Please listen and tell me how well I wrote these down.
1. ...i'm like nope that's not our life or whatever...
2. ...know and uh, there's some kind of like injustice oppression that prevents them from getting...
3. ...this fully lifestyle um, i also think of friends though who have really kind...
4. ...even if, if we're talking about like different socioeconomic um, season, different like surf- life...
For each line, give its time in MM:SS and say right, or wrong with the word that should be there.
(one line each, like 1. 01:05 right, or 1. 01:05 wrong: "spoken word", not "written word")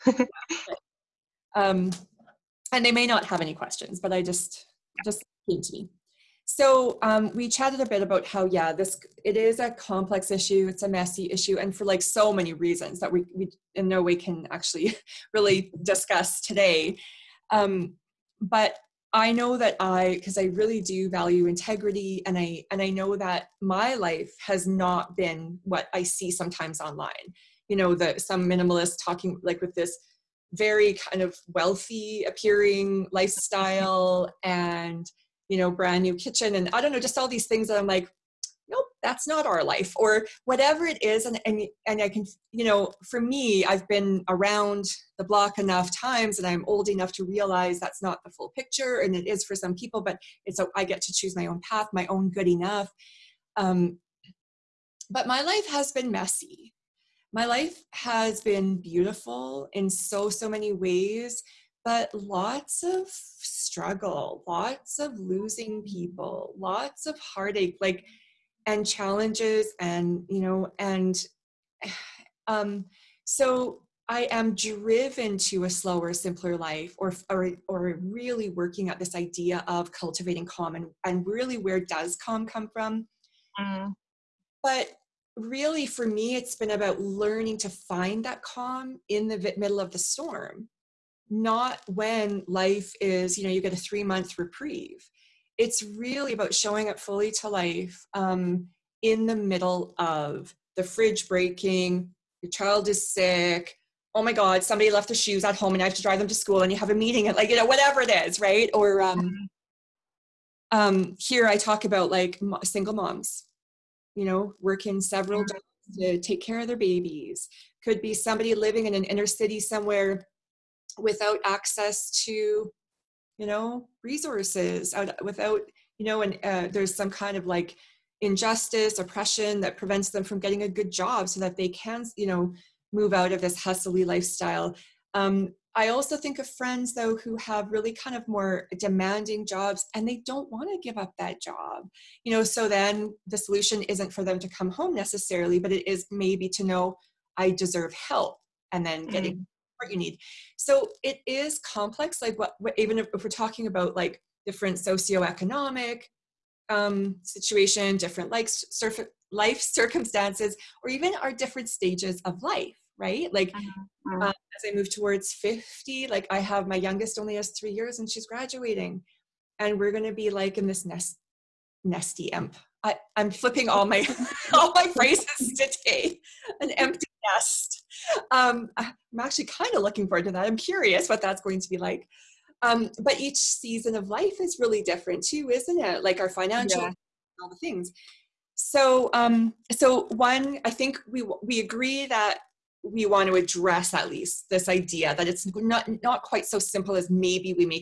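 1. 00:37 right
2. 02:06 right
3. 02:13 wrong: "hustly", not "fully"
4. 02:32 wrong: "situation", not "season".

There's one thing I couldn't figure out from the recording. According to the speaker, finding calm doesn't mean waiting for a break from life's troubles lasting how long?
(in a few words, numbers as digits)
3 months.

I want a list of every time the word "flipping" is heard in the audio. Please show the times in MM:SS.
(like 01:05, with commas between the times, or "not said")
02:53.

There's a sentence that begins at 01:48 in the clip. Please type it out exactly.
Or um, um, here I talk about like single moms, you know, working several mm.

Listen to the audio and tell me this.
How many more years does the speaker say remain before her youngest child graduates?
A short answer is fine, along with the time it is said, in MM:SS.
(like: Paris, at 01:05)
3, at 02:47.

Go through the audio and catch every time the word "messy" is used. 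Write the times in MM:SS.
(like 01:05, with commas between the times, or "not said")
00:10, 00:56.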